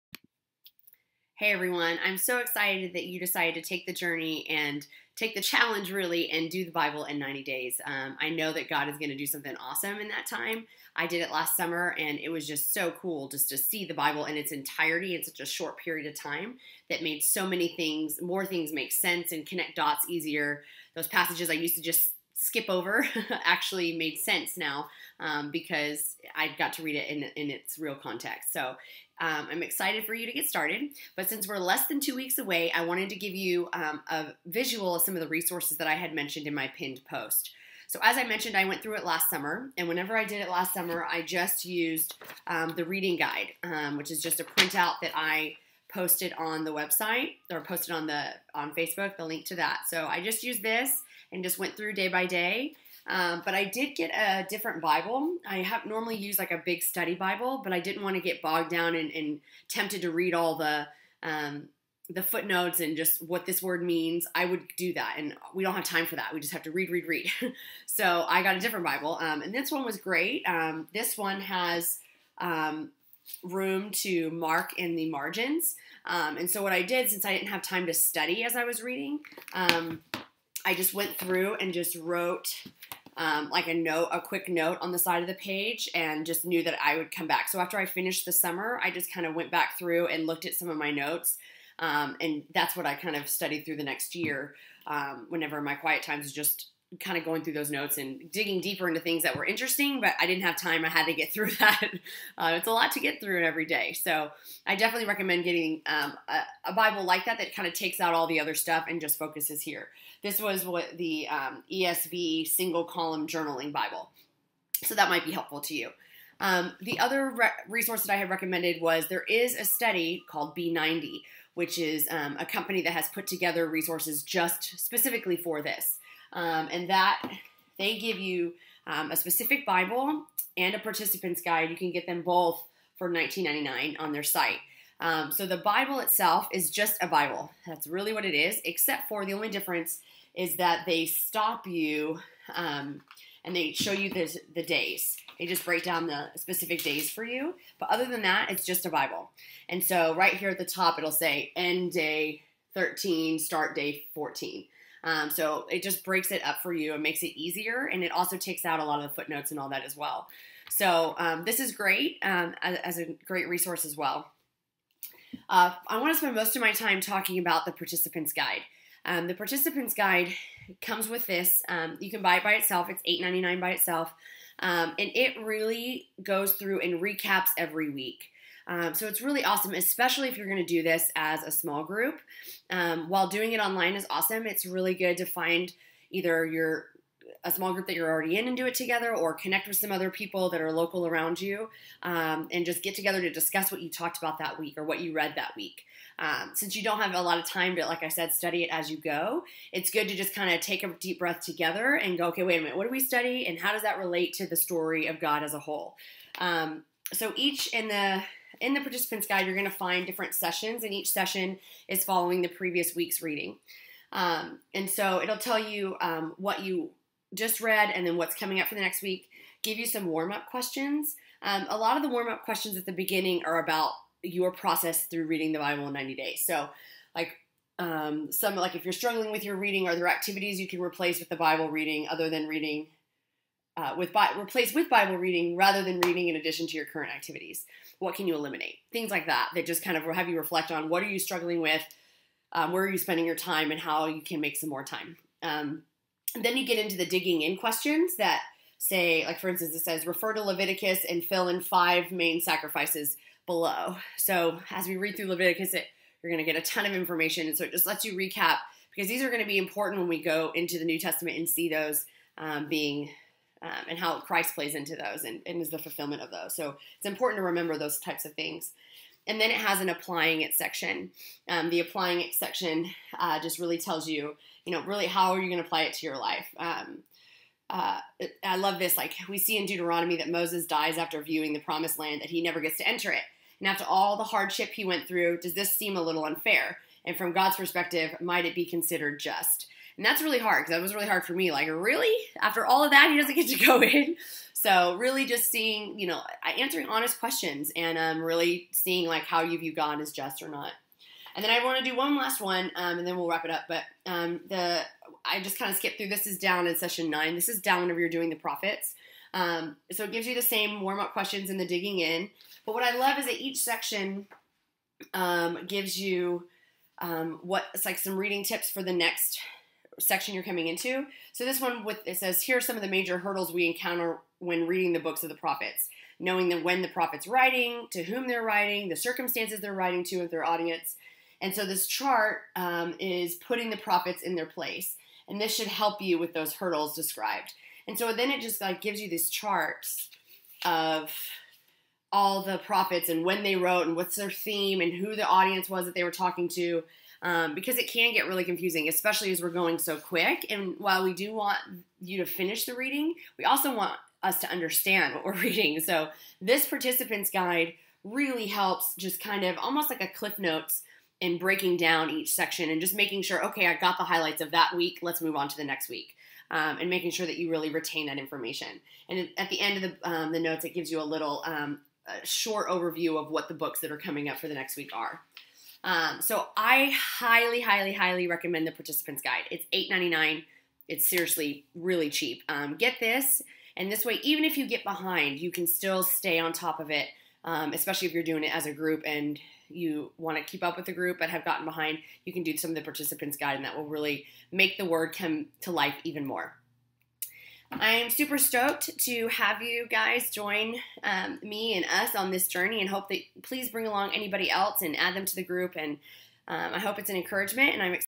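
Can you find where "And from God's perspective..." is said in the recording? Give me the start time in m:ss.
4:47.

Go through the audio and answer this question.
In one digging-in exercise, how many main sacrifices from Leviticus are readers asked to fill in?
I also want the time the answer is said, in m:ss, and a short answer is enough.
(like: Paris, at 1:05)
5, at 4:11.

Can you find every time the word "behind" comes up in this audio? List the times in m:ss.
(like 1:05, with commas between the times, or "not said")
6:24, 6:31.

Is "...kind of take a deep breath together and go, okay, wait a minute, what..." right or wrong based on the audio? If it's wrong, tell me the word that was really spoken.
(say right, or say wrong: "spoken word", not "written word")
right.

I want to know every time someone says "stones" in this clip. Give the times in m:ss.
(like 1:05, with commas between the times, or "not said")
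not said.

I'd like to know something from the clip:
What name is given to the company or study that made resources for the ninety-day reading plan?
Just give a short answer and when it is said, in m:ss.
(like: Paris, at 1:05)
B90, at 2:00.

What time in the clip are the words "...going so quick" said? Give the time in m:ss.
5:49.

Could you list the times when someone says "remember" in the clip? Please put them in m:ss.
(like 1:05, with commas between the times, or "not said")
4:27.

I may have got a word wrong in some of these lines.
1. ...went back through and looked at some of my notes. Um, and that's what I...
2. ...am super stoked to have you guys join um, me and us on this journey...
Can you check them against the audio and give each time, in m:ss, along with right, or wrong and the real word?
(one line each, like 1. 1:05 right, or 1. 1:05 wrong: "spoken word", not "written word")
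1. 1:29 right
2. 6:37 right.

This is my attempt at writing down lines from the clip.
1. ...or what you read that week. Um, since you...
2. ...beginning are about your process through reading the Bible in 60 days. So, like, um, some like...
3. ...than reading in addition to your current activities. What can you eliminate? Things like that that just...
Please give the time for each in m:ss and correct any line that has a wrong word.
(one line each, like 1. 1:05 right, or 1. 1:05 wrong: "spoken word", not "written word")
1. 3:14 right
2. 3:42 wrong: "90", not "60"
3. 3:55 right.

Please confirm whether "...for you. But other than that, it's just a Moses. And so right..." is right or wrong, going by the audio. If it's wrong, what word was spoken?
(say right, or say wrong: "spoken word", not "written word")
wrong: "Bible", not "Moses".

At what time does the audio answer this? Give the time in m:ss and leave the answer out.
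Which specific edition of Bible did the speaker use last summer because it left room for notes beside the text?
1:51.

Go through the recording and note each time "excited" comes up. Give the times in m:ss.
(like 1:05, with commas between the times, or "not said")
0:02, 0:29.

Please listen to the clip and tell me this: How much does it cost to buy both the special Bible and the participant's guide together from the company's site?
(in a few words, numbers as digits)
$19.99.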